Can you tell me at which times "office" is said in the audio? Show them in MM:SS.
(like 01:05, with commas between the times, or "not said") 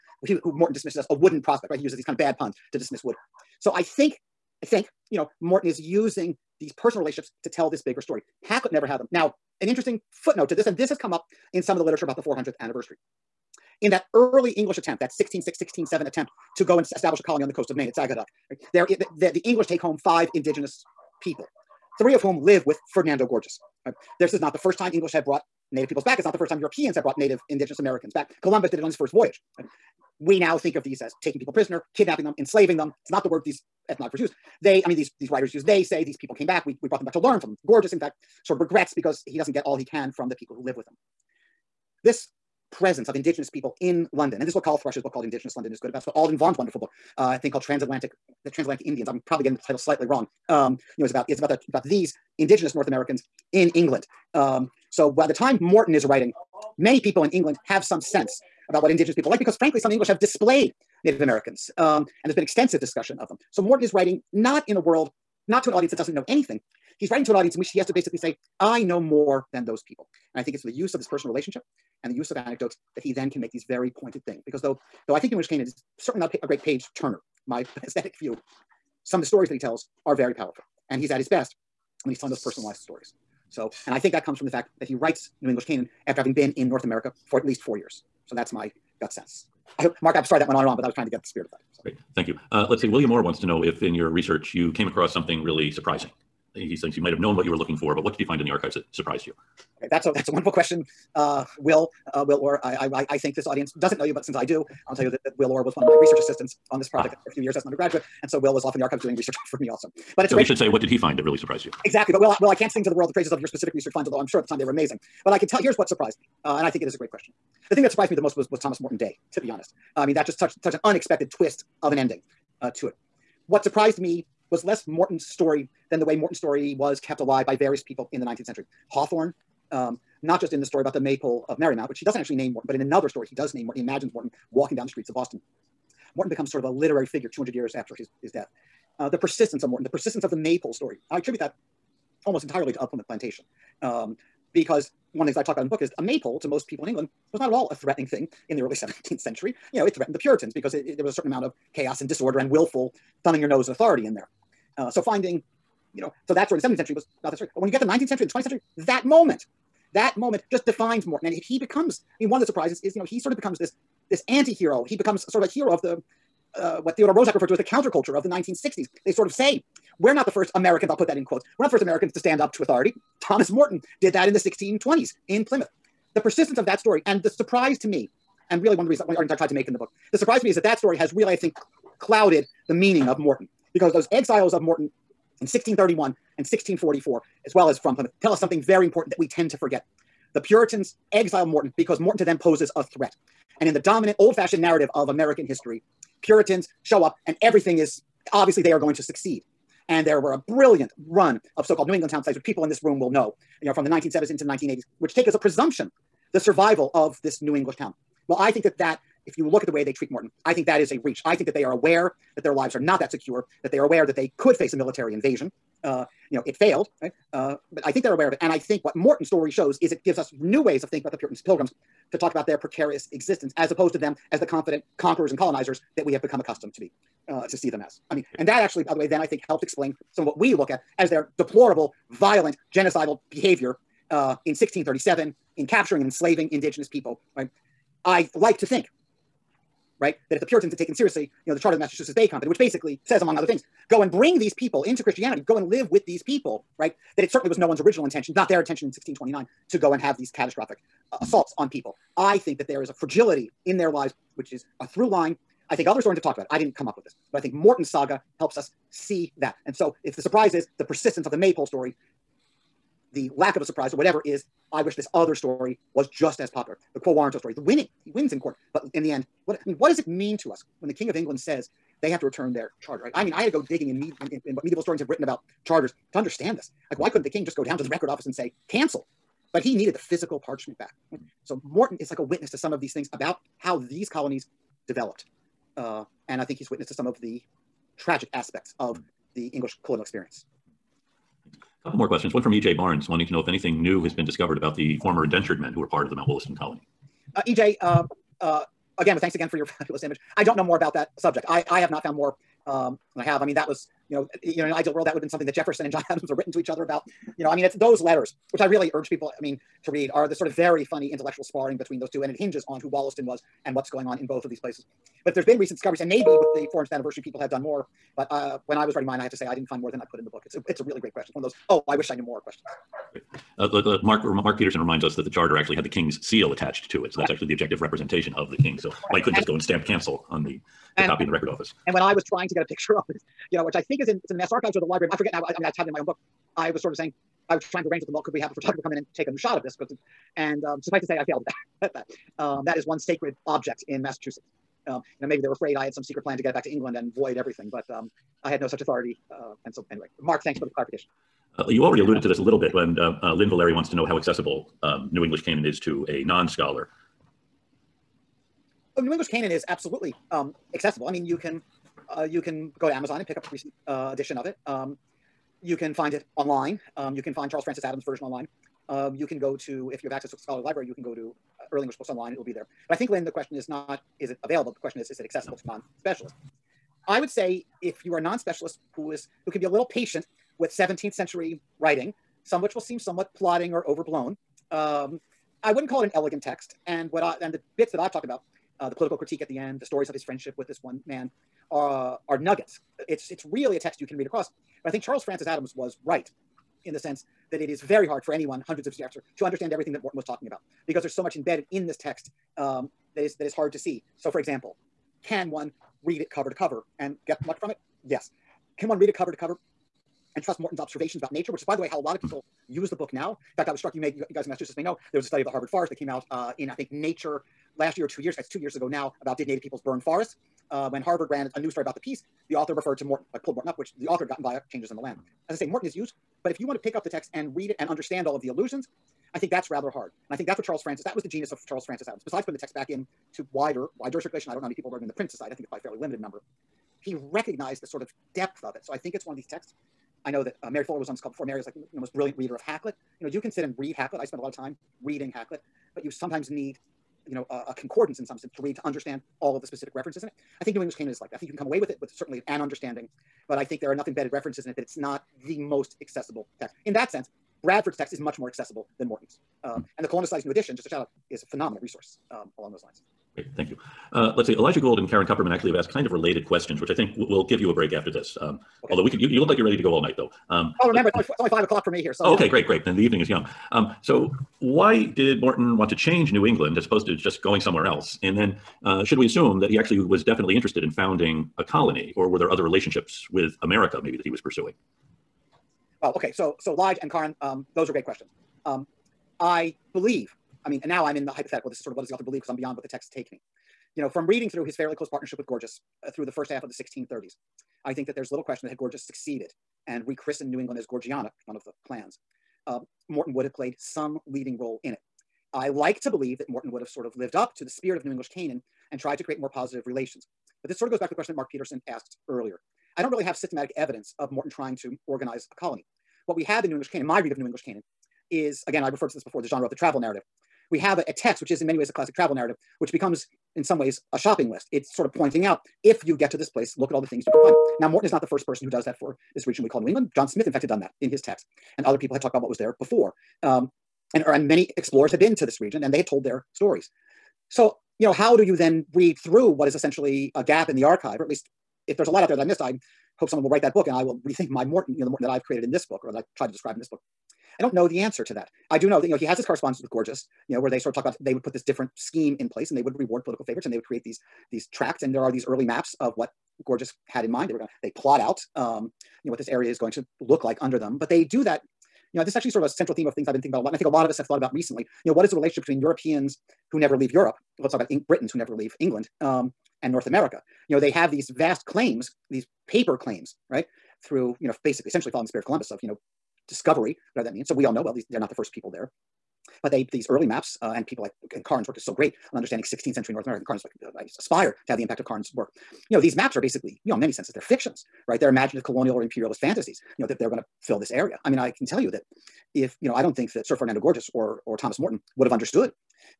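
04:38, 05:31.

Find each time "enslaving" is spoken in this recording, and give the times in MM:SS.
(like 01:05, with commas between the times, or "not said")
00:32, 03:56.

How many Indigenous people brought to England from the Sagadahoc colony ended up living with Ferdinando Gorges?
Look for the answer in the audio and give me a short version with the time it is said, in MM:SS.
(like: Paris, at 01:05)
3, at 00:21.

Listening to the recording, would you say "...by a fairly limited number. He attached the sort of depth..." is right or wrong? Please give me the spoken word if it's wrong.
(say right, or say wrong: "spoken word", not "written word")
wrong: "recognized", not "attached".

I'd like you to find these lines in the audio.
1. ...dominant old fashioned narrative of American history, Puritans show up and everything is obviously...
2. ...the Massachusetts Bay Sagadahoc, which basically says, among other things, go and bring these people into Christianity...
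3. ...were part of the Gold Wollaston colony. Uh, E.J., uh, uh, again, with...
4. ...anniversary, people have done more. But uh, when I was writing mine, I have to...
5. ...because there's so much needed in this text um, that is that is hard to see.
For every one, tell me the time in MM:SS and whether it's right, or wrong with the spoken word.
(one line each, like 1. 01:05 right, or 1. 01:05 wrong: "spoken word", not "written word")
1. 03:13 right
2. 04:01 wrong: "Company", not "Sagadahoc"
3. 04:55 wrong: "Mount", not "Gold"
4. 05:16 right
5. 06:40 wrong: "embedded", not "needed".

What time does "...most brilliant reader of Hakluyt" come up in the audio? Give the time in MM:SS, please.
07:21.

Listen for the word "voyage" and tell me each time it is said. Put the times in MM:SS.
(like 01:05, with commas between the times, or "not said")
00:29.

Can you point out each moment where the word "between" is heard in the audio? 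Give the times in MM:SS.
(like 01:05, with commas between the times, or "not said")
05:11, 09:25.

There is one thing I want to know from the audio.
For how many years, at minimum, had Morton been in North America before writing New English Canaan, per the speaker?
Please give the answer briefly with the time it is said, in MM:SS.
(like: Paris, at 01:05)
4, at 01:27.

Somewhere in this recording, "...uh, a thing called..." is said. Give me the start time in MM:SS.
00:47.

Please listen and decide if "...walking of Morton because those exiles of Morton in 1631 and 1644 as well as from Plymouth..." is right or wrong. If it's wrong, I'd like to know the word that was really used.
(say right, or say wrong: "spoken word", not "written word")
wrong: "meaning", not "walking".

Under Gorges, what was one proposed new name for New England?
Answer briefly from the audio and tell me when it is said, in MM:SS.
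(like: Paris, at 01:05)
Gorgeana, at 08:20.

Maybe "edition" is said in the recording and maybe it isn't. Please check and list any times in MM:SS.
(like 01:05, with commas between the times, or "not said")
06:04, 07:40.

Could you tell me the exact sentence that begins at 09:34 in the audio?
Through, you know, basically, essentially following the spirit of Columbus of, you know, discovery, whatever that means.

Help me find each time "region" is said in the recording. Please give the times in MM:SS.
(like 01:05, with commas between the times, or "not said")
08:49, 08:55.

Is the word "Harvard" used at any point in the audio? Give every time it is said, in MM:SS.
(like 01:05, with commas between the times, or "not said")
06:55, 07:01.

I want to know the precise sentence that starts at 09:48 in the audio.
They're imaginative colonial or imperialist fantasies.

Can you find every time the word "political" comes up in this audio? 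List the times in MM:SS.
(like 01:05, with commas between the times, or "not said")
06:28, 09:13.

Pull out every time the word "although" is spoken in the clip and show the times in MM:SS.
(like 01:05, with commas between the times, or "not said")
01:54, 07:48.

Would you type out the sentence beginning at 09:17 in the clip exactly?
They were going to, they plot out, um, you know, what this area is going to look like under them.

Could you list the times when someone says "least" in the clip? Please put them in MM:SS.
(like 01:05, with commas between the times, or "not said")
01:27, 09:01.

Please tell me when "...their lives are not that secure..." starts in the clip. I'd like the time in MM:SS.
03:32.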